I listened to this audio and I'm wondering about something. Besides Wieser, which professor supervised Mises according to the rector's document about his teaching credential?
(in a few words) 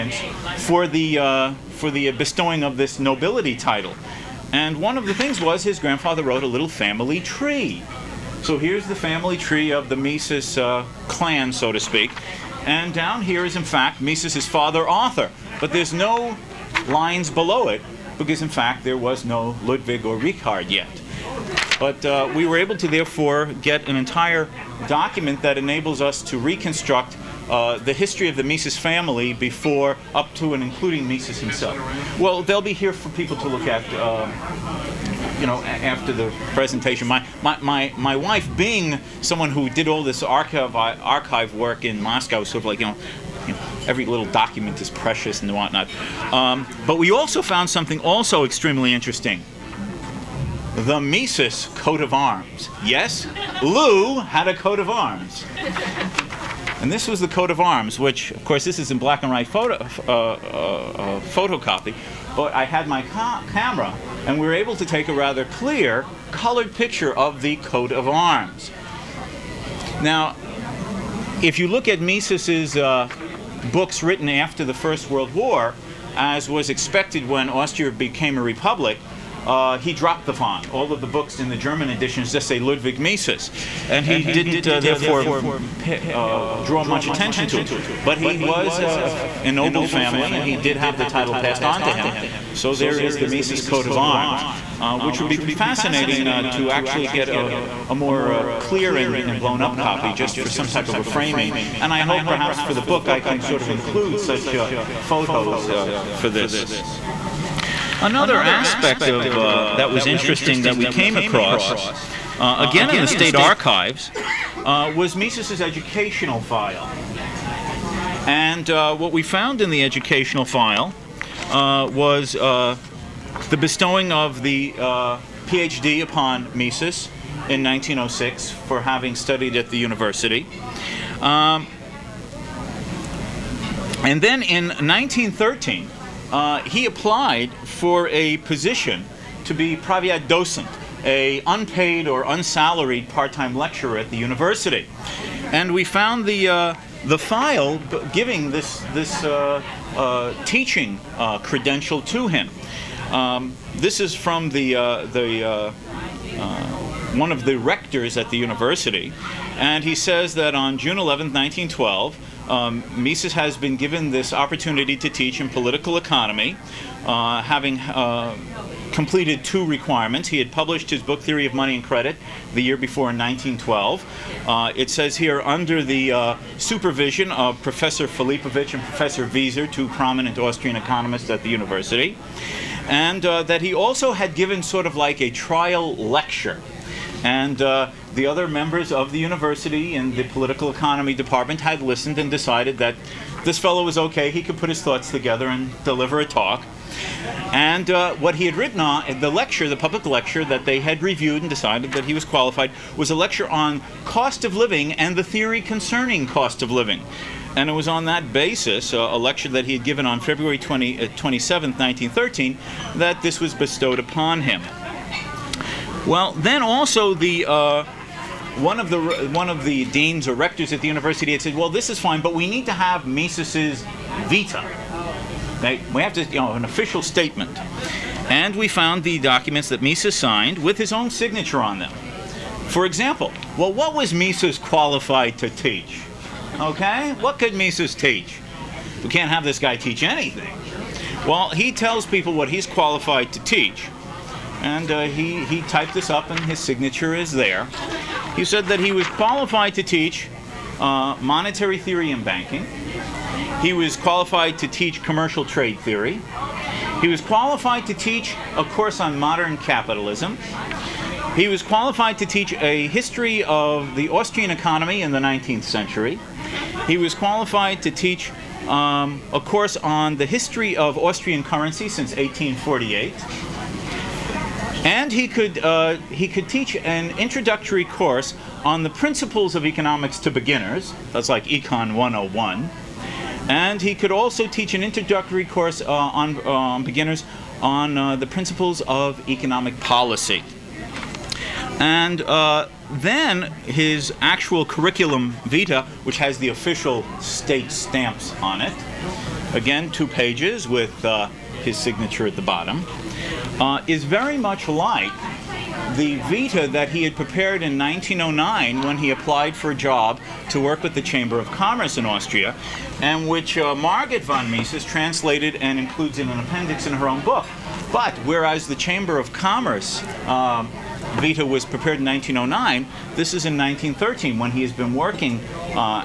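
Philippovich.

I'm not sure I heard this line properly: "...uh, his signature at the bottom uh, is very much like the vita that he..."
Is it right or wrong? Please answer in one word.
right.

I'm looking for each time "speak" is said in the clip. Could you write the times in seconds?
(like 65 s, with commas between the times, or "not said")
11 s.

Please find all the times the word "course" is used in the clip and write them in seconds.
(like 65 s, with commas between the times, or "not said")
58 s, 258 s, 269 s, 277 s, 285 s.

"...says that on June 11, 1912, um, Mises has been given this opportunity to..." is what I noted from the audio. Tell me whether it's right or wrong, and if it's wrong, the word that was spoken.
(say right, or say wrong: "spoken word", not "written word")
right.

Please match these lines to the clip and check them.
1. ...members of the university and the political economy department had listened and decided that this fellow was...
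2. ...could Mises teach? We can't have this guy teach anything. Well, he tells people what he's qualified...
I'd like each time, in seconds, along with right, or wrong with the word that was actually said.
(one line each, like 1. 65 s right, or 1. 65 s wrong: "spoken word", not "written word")
1. 188 s right
2. 237 s right.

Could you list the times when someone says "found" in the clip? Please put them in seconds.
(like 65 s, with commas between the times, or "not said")
47 s, 119 s, 145 s, 228 s.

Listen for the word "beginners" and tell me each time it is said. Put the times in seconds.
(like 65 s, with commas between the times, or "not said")
280 s, 286 s.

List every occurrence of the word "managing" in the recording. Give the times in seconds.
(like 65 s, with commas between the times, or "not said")
not said.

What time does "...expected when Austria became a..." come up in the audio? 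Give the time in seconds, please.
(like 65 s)
76 s.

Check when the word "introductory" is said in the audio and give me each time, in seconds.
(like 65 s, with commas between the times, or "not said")
277 s, 284 s.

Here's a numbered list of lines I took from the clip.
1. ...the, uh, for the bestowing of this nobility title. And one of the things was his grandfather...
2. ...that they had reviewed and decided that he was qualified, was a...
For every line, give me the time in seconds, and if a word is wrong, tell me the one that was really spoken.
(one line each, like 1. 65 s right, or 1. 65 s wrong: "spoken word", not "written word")
1. 0 s right
2. 200 s right.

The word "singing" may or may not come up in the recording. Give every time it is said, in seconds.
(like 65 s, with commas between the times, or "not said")
not said.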